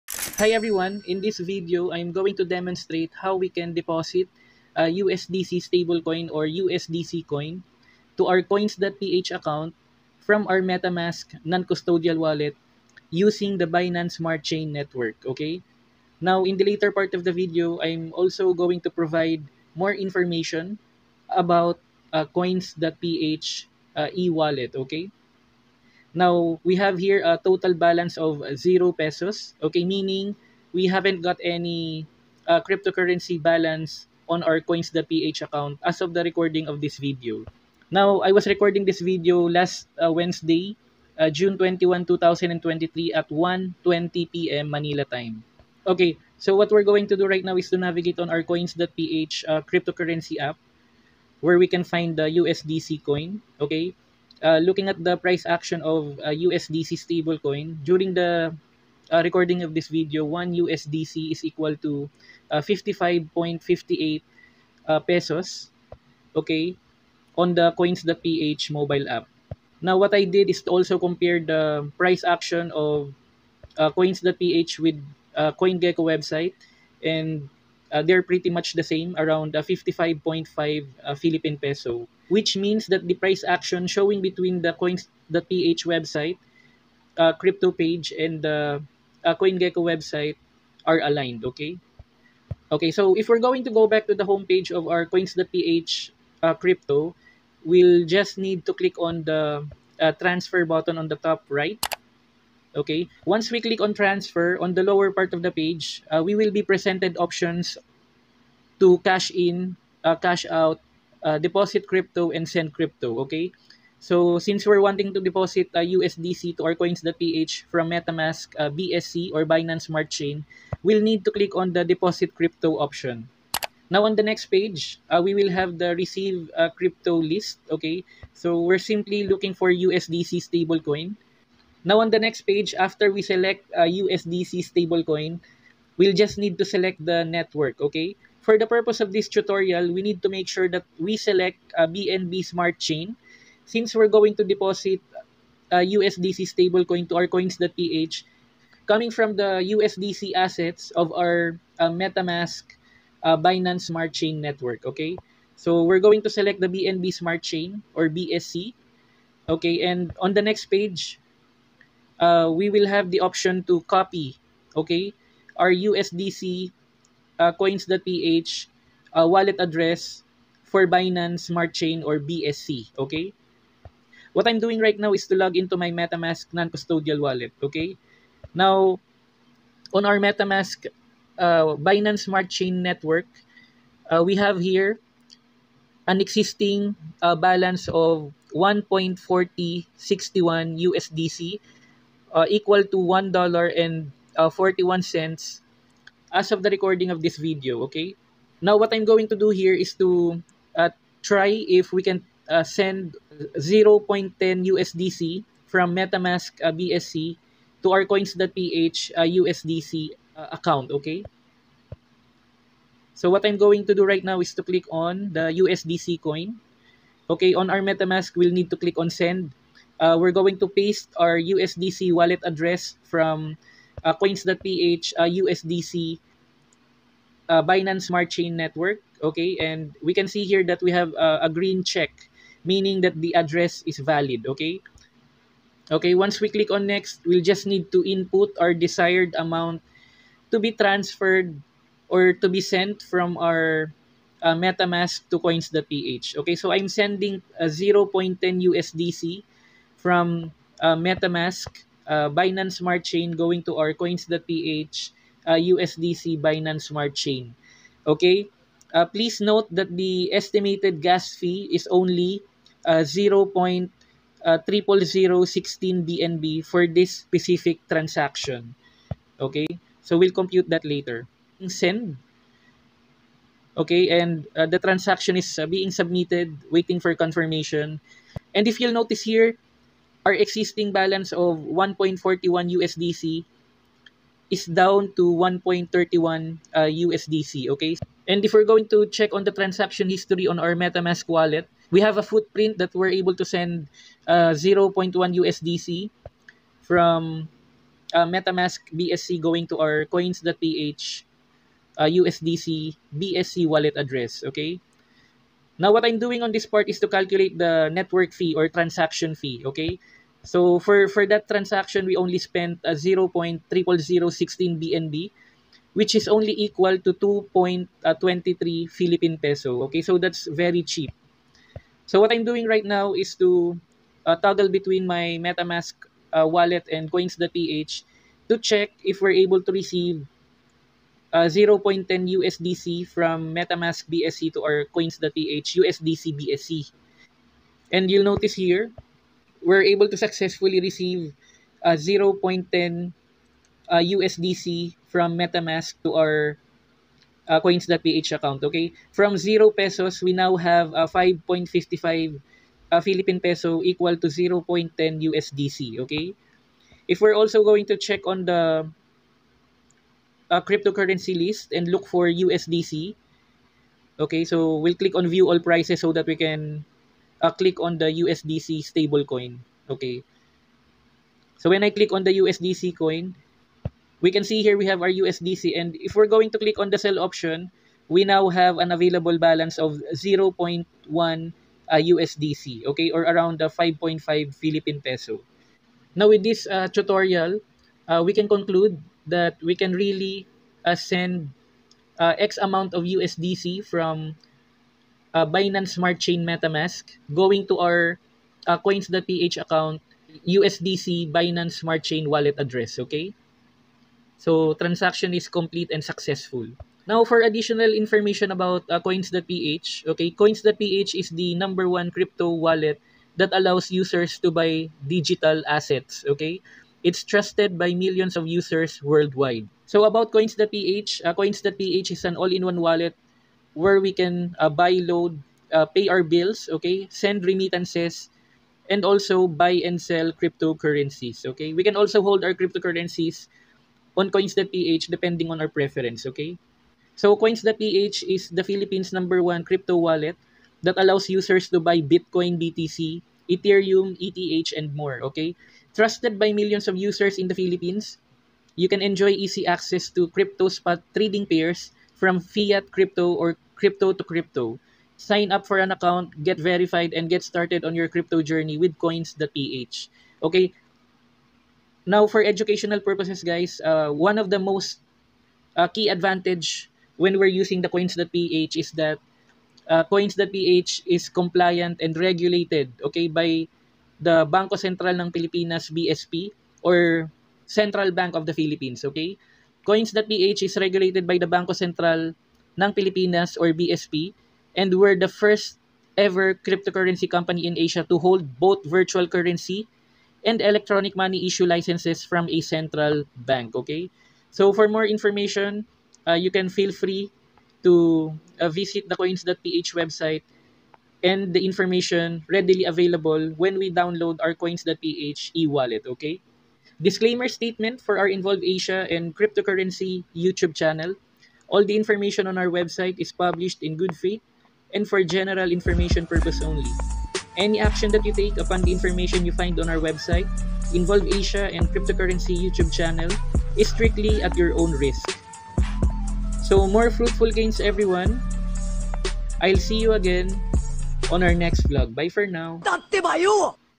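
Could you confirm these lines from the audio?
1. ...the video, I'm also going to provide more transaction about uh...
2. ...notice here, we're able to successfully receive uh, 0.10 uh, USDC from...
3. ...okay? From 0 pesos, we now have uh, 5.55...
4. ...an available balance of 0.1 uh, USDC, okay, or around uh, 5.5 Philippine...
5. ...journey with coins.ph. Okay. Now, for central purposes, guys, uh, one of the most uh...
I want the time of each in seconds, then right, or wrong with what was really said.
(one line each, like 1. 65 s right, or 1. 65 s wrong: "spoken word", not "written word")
1. 17 s wrong: "information", not "transaction"
2. 338 s right
3. 348 s right
4. 378 s right
5. 458 s wrong: "educational", not "central".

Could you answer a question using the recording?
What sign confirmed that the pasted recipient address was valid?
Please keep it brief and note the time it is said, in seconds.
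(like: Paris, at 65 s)
A green check, at 231 s.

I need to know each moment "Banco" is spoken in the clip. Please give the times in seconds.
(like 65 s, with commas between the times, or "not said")
474 s, 481 s.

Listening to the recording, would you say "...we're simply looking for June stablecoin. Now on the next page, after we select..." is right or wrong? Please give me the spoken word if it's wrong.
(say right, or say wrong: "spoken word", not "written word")
wrong: "USDC", not "June".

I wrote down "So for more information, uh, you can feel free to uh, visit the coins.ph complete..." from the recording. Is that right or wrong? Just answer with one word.
wrong.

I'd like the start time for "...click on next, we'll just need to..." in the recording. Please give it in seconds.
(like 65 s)
236 s.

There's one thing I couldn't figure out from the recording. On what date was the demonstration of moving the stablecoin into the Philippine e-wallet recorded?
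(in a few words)
June 21, 2023.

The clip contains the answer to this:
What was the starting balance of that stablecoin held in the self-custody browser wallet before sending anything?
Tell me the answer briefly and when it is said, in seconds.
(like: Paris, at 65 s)
1.4061 USDC, at 188 s.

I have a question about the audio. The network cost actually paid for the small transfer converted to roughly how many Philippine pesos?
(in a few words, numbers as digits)
2.23 pesos.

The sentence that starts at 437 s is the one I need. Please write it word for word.
So Coins.ph is the Philippines' number one crypto wallet that allows users to buy Bitcoin, BTC, Ethereum, ETH, and more, okay?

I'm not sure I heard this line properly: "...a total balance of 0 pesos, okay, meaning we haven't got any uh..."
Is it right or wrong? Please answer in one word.
right.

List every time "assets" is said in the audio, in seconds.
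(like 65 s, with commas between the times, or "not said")
150 s, 415 s.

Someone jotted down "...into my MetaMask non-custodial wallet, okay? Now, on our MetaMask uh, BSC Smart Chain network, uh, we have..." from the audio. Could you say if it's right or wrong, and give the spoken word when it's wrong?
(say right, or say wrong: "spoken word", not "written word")
wrong: "Binance", not "BSC".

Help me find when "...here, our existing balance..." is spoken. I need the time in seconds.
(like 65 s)
279 s.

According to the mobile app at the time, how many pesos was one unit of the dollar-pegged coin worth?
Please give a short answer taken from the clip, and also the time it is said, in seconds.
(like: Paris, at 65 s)
55.58 pesos, at 62 s.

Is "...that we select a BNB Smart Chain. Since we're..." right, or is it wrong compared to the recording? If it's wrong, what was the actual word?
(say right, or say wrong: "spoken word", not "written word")
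right.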